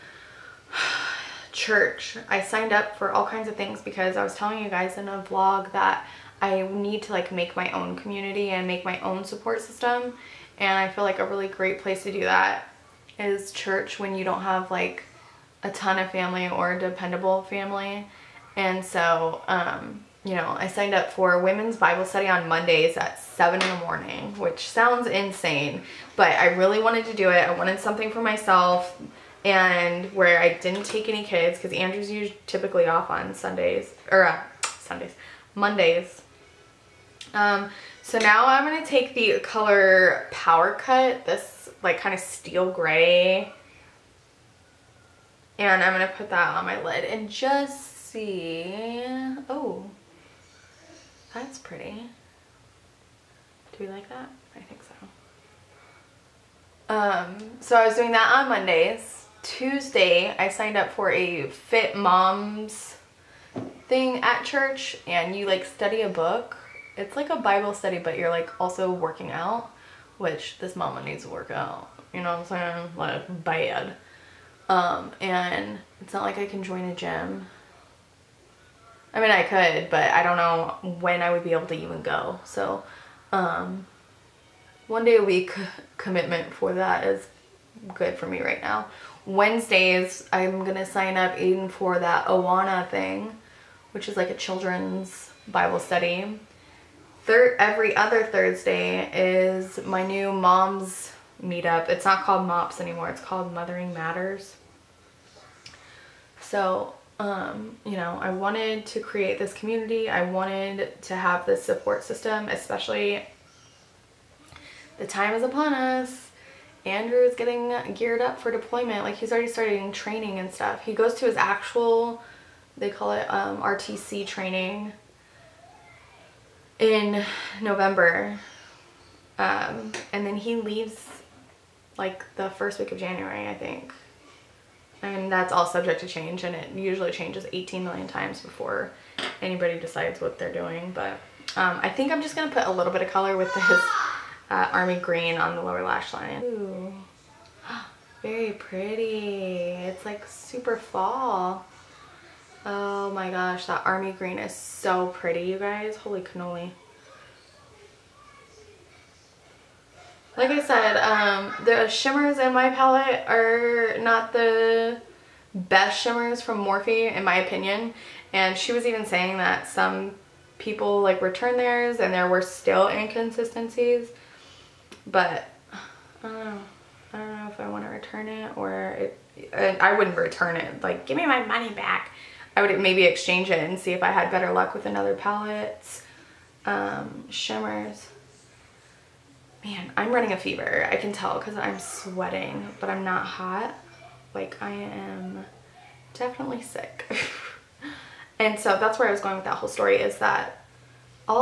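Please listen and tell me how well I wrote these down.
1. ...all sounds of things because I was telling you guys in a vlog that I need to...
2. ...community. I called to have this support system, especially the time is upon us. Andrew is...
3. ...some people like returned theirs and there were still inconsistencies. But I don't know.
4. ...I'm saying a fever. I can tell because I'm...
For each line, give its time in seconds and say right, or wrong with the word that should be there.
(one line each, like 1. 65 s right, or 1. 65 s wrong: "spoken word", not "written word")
1. 3 s wrong: "kinds", not "sounds"
2. 109 s wrong: "wanted", not "called"
3. 169 s right
4. 189 s wrong: "running", not "saying".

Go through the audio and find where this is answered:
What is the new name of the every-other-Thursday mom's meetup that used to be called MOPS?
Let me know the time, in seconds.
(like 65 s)
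103 s.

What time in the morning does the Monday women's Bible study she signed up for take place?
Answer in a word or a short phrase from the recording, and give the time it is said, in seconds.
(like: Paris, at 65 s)
7, at 23 s.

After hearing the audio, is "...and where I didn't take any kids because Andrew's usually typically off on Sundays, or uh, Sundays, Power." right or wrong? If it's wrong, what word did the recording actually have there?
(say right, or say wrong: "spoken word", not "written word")
wrong: "Mondays", not "Power".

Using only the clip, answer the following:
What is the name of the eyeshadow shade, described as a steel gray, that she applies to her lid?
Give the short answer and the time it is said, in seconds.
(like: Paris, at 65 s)
Power Cut, at 40 s.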